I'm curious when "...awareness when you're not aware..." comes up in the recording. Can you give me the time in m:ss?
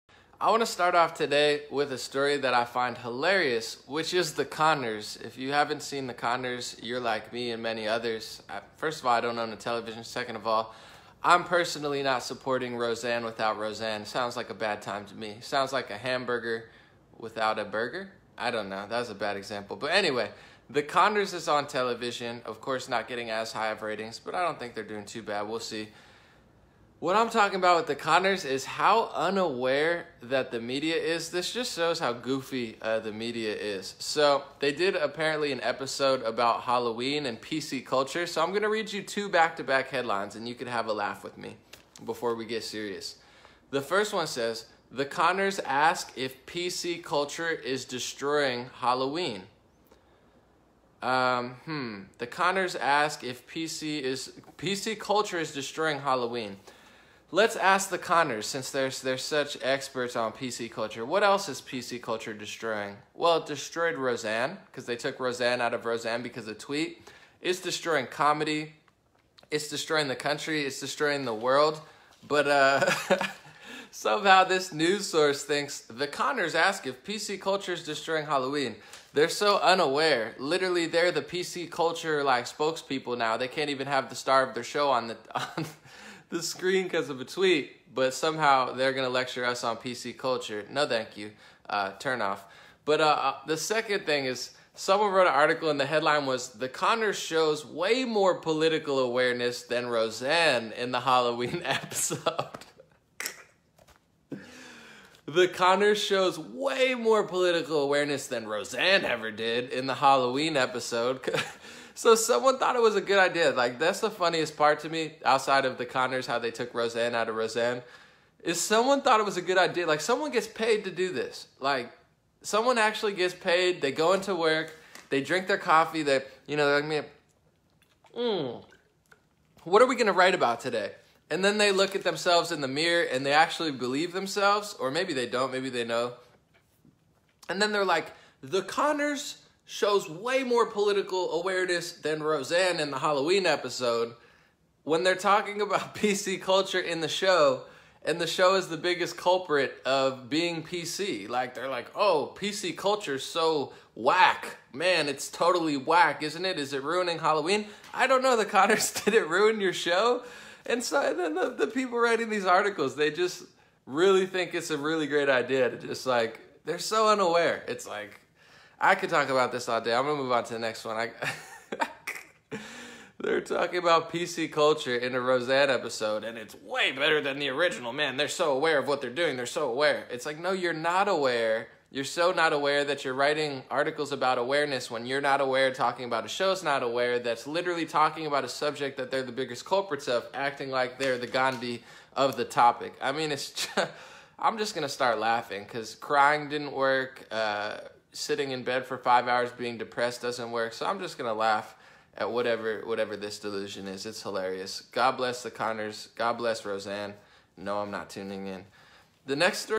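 3:04.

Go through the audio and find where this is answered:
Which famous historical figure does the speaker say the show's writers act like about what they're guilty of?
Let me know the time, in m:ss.
3:11.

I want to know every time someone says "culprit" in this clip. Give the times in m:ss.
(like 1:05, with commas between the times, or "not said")
2:29, 3:09.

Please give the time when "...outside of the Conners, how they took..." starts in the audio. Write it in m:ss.
1:55.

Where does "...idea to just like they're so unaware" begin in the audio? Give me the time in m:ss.
2:45.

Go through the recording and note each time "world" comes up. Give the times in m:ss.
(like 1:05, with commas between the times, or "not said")
1:11.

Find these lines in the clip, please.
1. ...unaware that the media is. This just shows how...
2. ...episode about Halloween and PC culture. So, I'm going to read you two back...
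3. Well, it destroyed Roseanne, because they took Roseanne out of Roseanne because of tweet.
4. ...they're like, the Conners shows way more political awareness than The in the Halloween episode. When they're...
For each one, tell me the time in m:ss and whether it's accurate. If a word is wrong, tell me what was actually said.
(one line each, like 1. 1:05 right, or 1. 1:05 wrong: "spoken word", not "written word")
1. 0:29 right
2. 0:35 right
3. 1:03 right
4. 2:17 wrong: "Roseanne", not "The".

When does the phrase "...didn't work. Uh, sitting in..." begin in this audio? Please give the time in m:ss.
3:16.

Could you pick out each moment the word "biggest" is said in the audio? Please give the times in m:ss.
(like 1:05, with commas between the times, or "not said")
2:28, 3:09.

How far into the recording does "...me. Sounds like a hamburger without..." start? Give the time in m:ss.
0:15.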